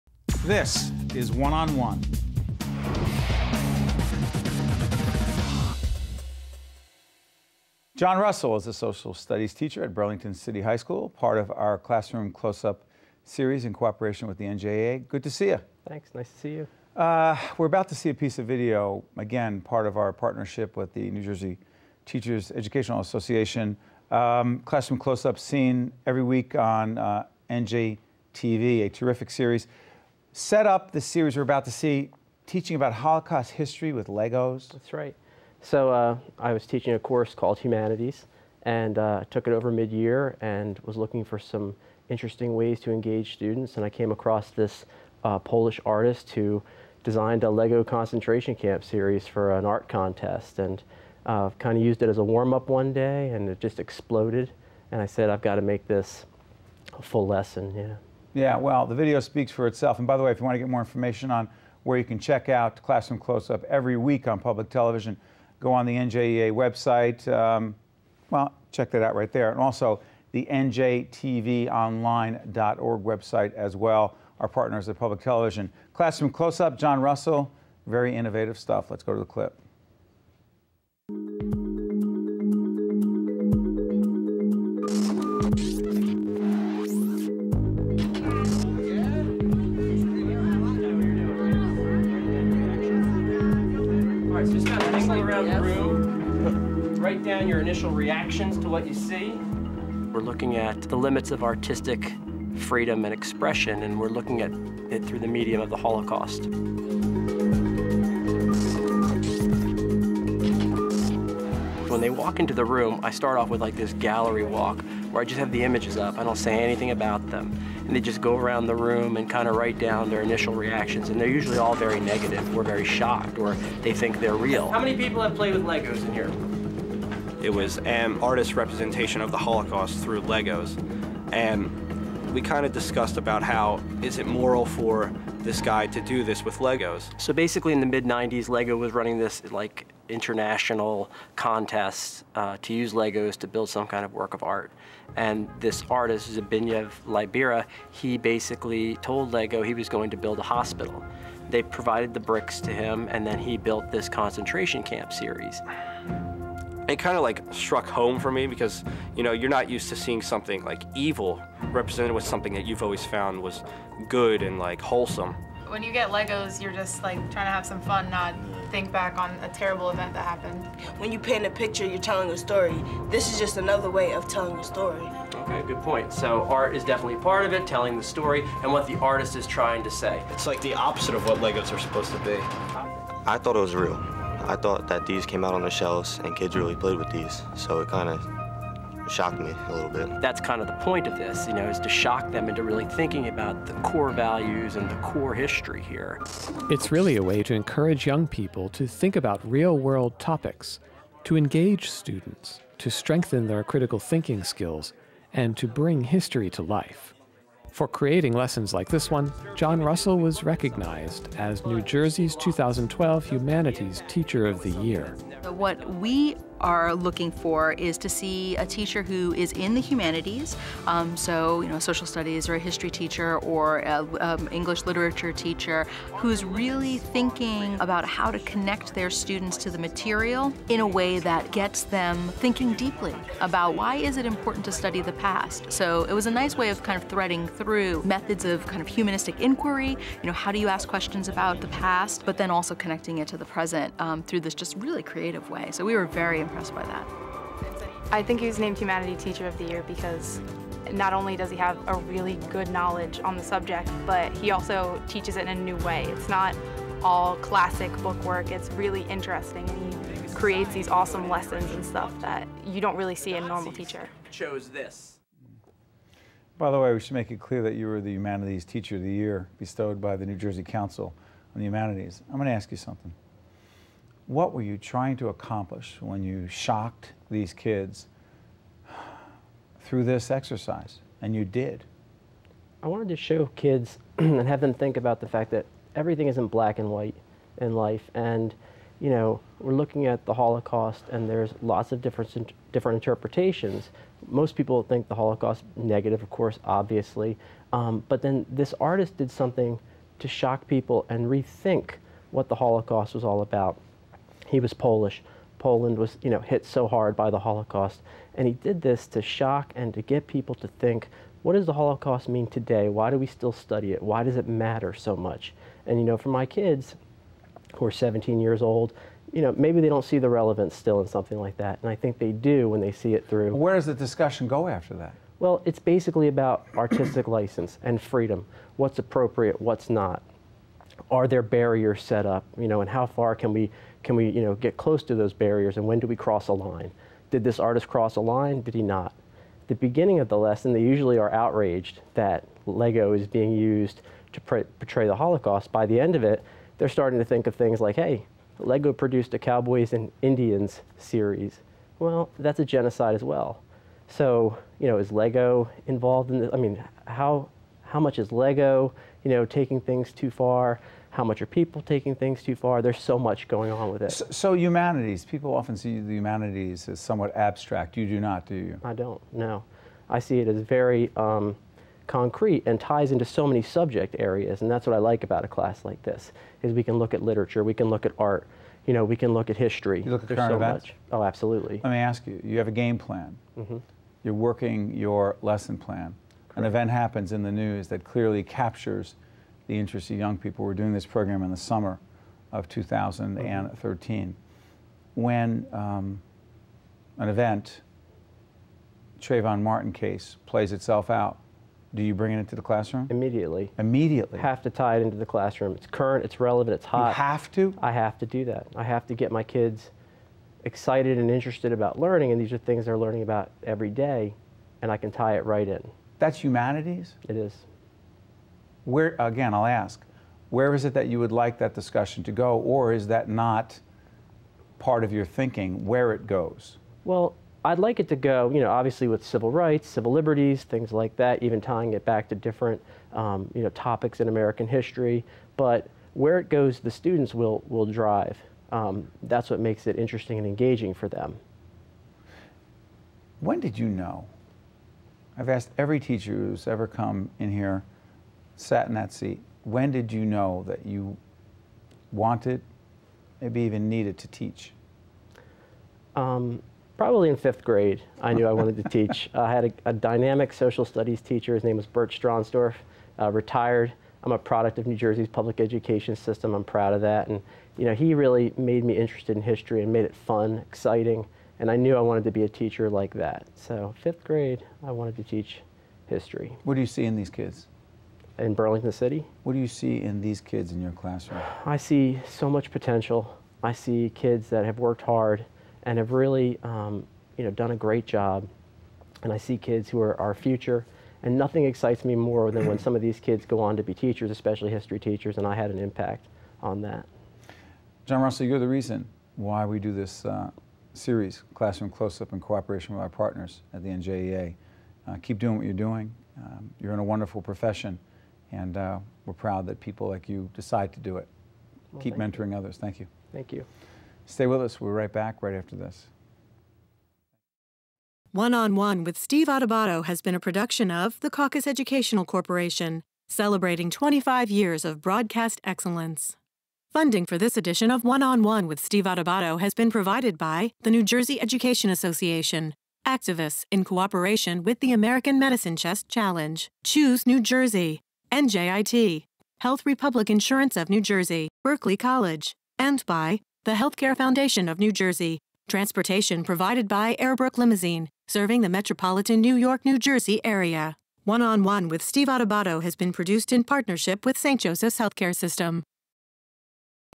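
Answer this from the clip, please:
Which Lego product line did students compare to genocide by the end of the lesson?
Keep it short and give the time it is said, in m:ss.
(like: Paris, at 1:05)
Cowboys and Indians, at 5:49.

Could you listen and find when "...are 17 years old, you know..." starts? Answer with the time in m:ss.
5:17.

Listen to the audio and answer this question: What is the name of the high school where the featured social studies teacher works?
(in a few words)
Burlington City High School.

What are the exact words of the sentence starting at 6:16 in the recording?
Is we can look at literature, we can look at art, you know, we can look at history.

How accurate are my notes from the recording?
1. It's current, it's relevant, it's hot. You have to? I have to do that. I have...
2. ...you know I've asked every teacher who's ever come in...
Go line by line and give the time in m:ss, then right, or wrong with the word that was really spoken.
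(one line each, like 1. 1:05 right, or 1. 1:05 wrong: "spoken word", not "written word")
1. 6:45 right
2. 7:23 right.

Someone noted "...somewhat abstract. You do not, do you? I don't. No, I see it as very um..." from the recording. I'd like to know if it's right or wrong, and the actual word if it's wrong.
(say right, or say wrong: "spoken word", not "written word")
right.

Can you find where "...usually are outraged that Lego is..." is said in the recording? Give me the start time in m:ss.
5:40.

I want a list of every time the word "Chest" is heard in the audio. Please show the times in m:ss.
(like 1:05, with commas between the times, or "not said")
8:55.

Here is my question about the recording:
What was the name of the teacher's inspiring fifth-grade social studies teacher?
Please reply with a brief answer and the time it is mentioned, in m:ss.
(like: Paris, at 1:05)
Bert Stronsdorf, at 7:41.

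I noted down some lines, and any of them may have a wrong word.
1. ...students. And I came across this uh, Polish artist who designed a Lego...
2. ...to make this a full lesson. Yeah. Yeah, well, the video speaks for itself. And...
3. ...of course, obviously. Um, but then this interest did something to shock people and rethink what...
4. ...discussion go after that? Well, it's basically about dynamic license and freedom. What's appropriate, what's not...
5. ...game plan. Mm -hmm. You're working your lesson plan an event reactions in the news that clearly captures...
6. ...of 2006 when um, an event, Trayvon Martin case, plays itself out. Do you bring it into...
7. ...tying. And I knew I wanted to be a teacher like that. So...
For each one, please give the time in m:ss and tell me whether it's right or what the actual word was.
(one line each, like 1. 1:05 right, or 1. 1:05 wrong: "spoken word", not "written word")
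1. 0:43 right
2. 0:55 right
3. 4:56 wrong: "artist", not "interest"
4. 5:23 wrong: "artistic", not "dynamic"
5. 6:22 wrong: "happens", not "reactions"
6. 6:32 wrong: "2013", not "2006"
7. 7:50 wrong: "exciting", not "tying".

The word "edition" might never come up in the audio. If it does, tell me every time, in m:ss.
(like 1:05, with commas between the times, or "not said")
8:47.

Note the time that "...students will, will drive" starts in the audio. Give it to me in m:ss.
7:16.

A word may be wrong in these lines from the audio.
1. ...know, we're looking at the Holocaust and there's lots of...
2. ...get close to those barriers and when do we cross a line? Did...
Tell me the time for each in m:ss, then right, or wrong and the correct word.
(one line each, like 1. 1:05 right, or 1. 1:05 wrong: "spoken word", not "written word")
1. 4:49 right
2. 5:34 right.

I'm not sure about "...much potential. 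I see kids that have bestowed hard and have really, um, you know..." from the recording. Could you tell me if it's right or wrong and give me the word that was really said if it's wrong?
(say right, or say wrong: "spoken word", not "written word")
wrong: "worked", not "bestowed".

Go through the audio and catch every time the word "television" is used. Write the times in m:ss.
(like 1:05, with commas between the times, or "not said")
1:04, 1:15.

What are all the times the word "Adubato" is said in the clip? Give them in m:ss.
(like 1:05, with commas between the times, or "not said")
8:39, 8:49, 9:12.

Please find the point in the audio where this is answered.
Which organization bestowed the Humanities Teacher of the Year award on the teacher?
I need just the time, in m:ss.
4:30.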